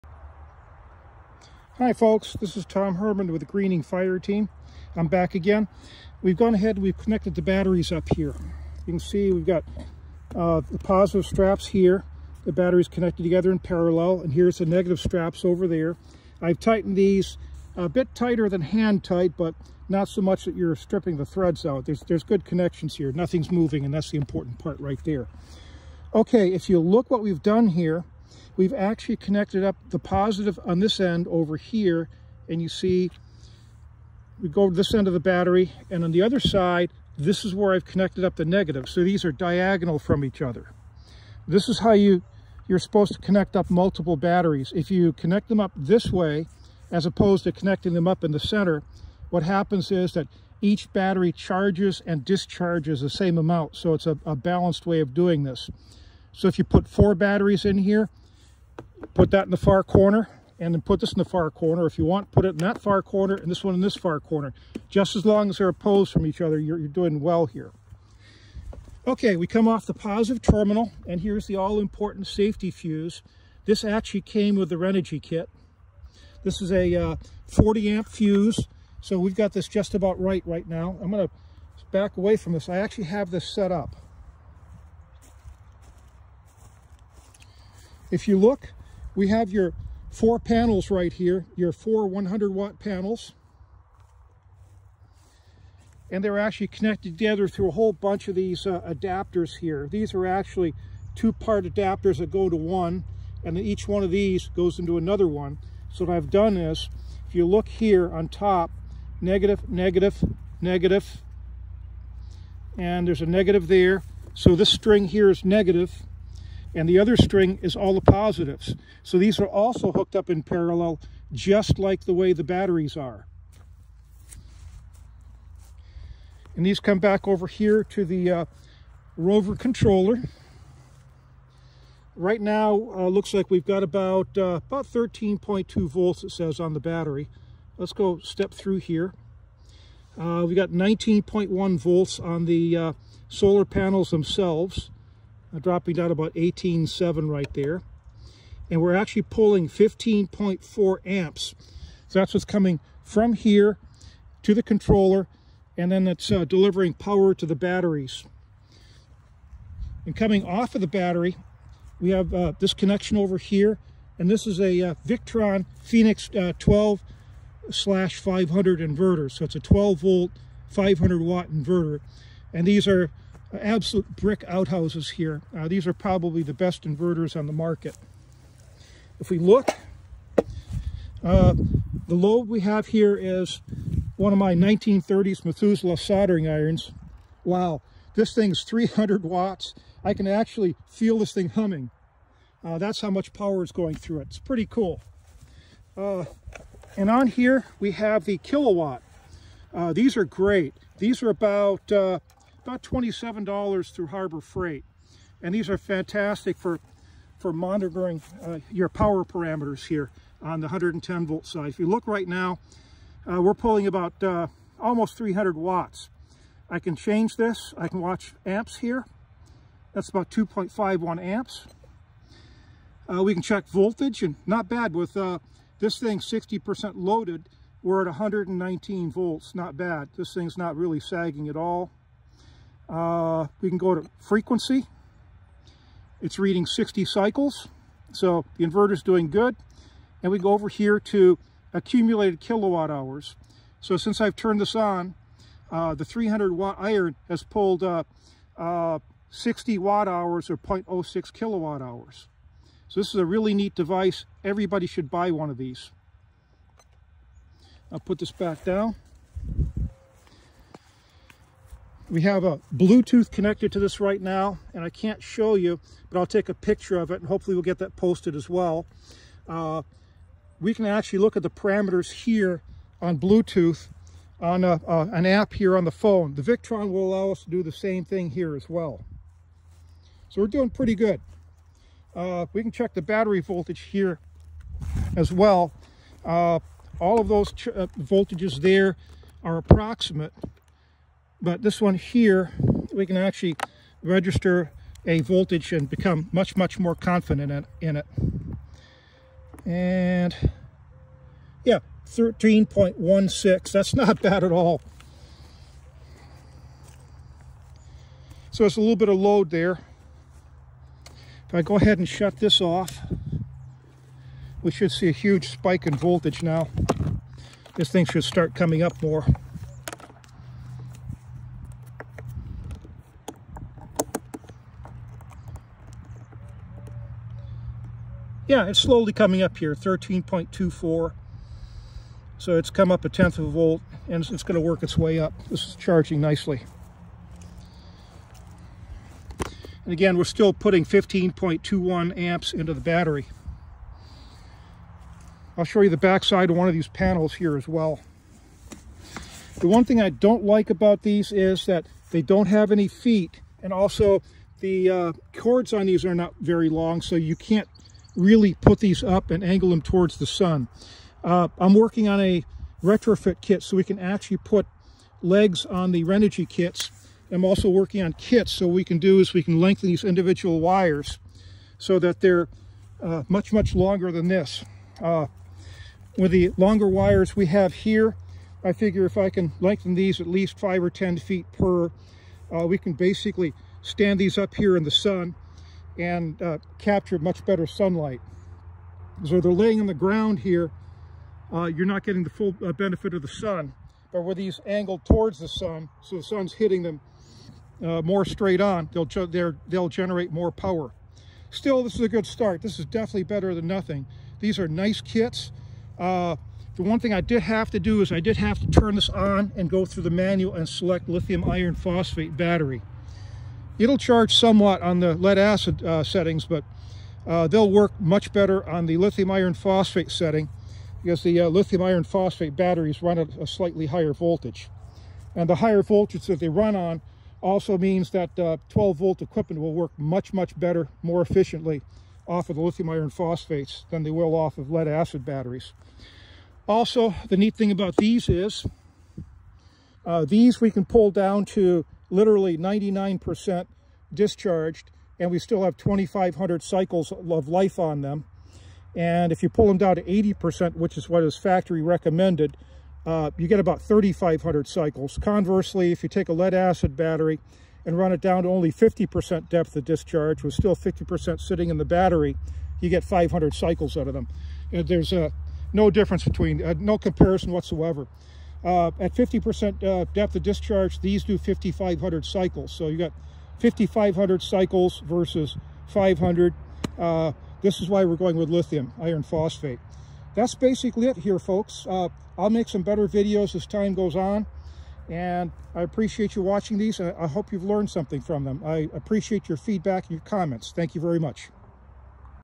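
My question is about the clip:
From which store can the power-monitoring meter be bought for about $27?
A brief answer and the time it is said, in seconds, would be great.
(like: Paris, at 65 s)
Harbor Freight, at 204 s.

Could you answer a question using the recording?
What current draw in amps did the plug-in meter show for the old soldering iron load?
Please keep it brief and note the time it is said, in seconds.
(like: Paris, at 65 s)
2.51 amps, at 220 s.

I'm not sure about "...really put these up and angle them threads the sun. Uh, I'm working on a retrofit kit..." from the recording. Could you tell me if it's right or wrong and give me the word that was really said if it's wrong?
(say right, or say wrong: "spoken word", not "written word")
wrong: "towards", not "threads".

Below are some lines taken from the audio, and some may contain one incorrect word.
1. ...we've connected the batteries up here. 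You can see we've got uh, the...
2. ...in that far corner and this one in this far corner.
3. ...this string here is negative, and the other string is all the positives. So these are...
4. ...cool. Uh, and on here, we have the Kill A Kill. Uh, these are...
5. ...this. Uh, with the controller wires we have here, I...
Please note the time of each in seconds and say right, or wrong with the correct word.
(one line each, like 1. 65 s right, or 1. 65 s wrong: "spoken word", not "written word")
1. 6 s right
2. 62 s right
3. 114 s right
4. 194 s wrong: "Watt", not "Kill"
5. 374 s wrong: "longer", not "controller".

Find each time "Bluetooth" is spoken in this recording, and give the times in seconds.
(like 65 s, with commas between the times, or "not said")
262 s, 273 s.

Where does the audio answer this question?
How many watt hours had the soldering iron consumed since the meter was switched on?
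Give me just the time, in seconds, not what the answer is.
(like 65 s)
249 s.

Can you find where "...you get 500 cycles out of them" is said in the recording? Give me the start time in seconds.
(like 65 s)
462 s.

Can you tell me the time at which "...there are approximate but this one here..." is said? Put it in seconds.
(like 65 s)
288 s.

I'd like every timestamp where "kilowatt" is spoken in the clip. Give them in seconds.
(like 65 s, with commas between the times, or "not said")
242 s, 251 s.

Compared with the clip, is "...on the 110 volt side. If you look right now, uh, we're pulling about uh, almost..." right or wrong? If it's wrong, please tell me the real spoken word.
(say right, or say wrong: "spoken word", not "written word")
right.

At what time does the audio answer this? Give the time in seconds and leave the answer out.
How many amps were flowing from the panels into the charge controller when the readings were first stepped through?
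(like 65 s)
149 s.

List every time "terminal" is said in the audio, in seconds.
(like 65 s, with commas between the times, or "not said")
70 s.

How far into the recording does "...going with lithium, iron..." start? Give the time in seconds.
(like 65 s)
478 s.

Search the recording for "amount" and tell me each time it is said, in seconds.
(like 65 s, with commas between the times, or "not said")
53 s.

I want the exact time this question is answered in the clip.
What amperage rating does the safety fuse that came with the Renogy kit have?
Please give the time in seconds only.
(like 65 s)
77 s.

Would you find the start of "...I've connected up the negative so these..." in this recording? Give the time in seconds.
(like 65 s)
37 s.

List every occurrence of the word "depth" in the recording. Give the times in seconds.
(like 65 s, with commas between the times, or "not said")
459 s, 470 s.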